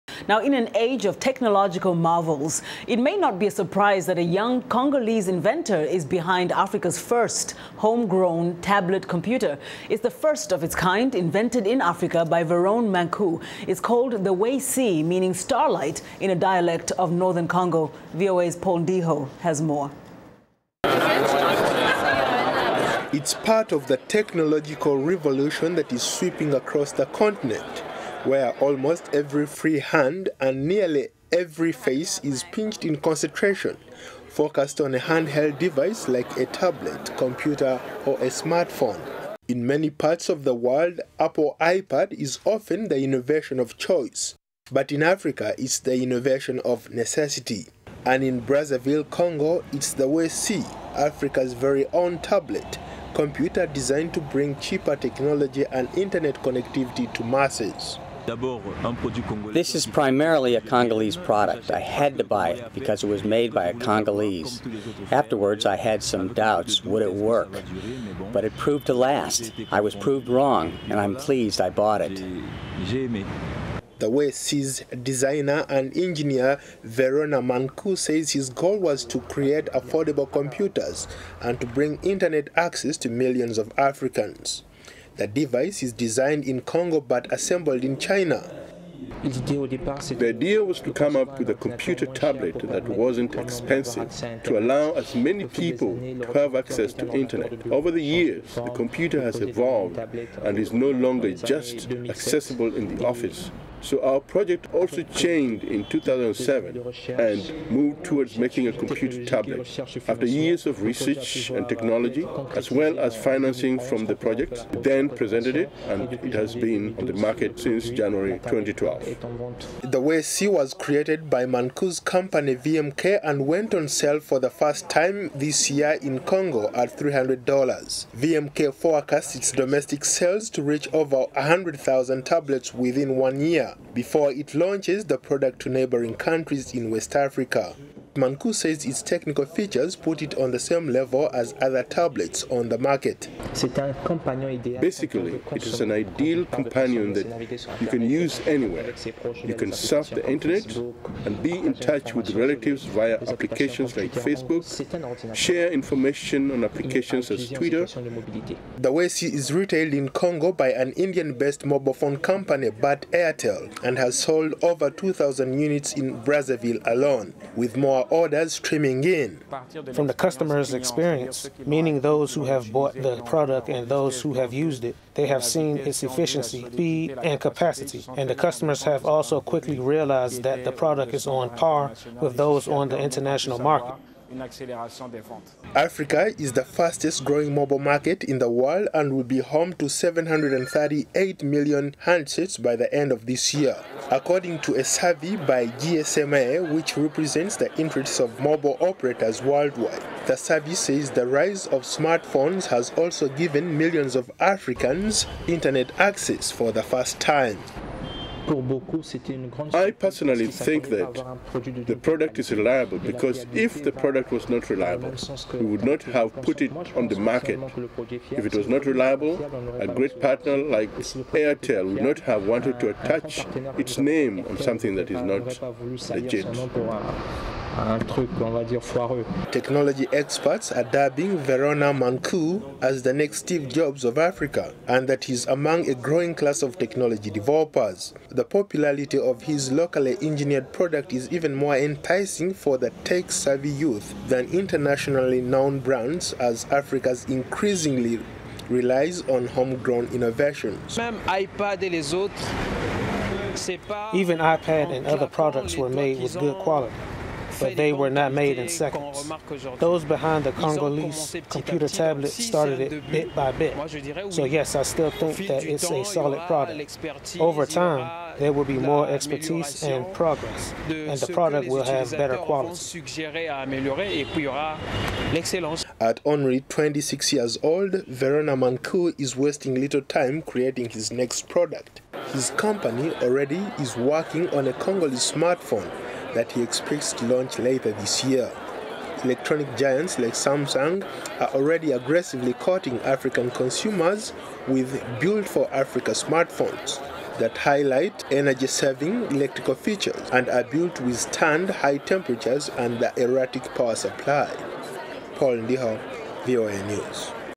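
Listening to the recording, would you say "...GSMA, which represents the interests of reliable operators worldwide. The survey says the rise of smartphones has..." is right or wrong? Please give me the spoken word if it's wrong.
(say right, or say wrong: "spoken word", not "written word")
wrong: "mobile", not "reliable".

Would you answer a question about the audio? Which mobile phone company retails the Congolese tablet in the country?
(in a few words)
Bharti Airtel.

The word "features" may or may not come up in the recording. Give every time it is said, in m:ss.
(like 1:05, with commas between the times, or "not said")
2:19, 4:59.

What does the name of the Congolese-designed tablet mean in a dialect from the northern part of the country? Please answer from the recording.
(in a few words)
starlight.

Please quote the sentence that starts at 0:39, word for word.
In many parts of the world, Apple iPad is often the innovation of choice, but in Africa, it's the innovation of necessity.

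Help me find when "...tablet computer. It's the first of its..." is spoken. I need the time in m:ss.
0:08.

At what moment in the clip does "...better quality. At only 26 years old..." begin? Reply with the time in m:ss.
4:32.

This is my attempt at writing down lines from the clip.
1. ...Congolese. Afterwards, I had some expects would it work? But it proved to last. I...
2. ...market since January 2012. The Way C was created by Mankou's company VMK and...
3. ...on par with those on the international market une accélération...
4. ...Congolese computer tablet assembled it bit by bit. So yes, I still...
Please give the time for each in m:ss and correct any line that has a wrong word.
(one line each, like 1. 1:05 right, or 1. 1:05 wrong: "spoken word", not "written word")
1. 1:03 wrong: "doubts", not "expects"
2. 1:57 right
3. 3:01 right
4. 4:20 wrong: "started", not "assembled".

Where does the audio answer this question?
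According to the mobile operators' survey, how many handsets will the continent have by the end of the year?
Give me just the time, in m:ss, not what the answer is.
3:09.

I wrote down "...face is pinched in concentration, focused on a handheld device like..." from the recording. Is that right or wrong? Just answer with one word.
right.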